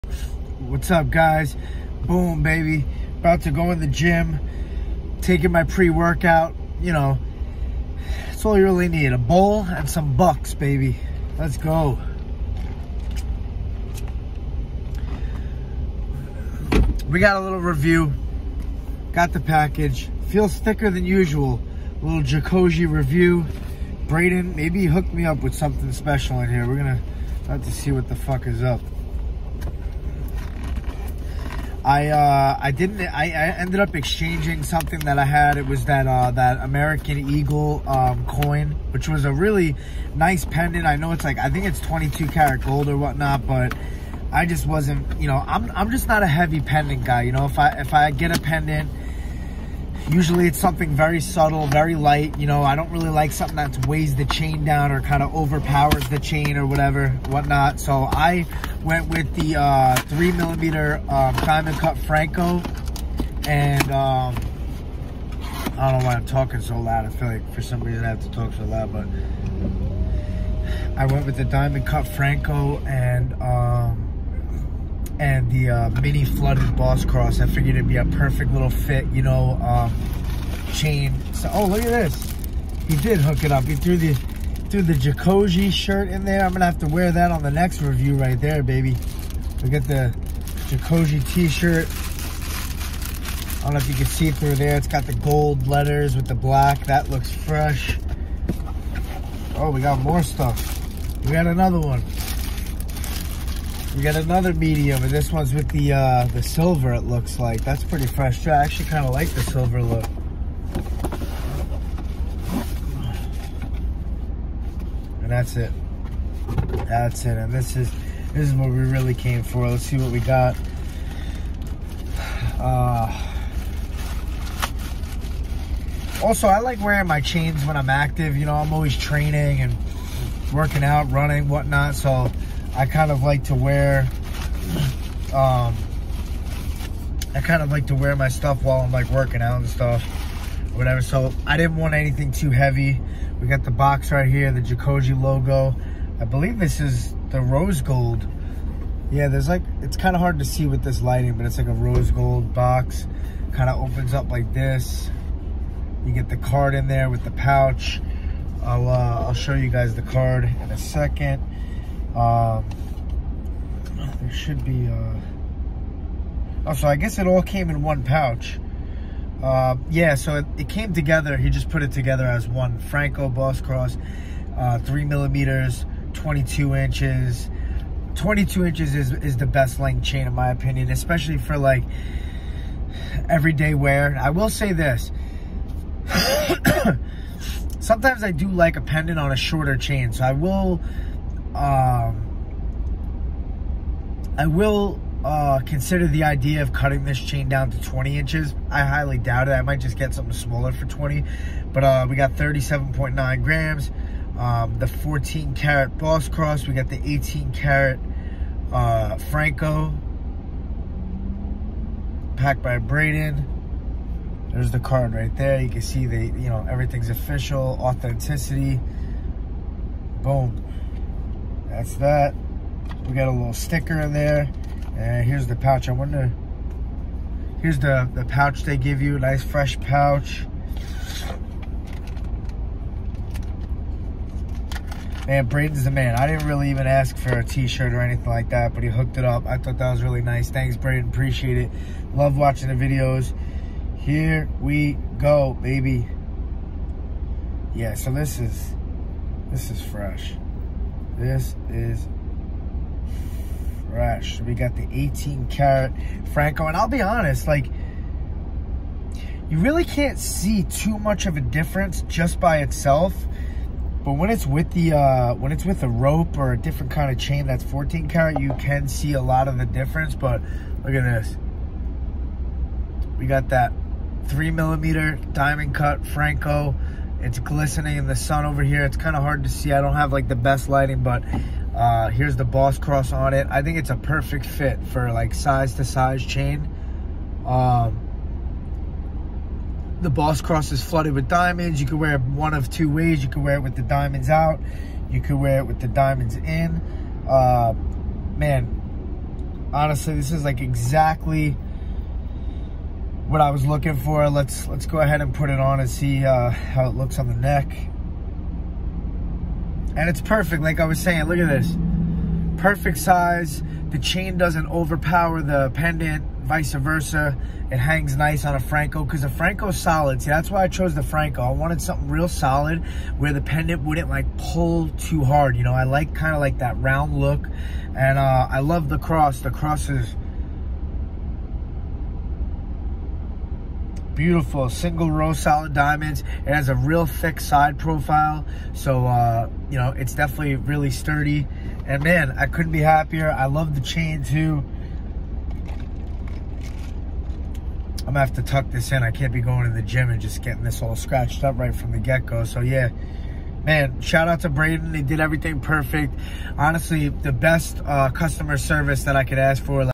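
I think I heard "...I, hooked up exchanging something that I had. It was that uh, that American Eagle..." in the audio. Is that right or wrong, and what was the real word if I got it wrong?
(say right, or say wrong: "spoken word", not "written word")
wrong: "ended", not "hooked".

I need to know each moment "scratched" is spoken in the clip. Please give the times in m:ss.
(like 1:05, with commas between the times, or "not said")
5:50.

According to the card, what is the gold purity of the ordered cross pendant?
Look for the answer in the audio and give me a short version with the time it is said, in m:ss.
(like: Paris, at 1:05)
14 karat, at 3:24.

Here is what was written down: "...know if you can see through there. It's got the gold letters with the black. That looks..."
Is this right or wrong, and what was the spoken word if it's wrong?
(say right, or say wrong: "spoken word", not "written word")
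right.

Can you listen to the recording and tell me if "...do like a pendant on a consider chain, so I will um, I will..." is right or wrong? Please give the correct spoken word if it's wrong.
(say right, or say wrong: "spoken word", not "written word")
wrong: "shorter", not "consider".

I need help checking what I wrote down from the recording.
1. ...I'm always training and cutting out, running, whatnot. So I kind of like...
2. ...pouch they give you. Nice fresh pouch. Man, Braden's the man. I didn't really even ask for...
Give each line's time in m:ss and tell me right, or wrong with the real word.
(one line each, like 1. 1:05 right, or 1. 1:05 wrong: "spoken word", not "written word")
1. 2:08 wrong: "working", not "cutting"
2. 3:48 right.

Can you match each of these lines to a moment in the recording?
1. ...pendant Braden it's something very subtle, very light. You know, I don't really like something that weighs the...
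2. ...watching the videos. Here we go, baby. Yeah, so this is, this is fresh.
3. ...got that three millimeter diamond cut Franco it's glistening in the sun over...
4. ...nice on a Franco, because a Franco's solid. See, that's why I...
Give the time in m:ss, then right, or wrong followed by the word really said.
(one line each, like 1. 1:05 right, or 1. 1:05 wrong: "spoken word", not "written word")
1. 0:48 wrong: "Usually", not "Braden"
2. 4:02 right
3. 4:33 right
4. 5:18 right.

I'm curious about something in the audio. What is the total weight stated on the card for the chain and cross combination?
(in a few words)
37.9 grams.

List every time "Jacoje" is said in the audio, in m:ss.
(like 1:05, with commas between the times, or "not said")
0:22, 1:24, 1:30, 2:24.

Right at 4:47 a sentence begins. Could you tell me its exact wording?
Um, the boss cross is flooded with diamonds.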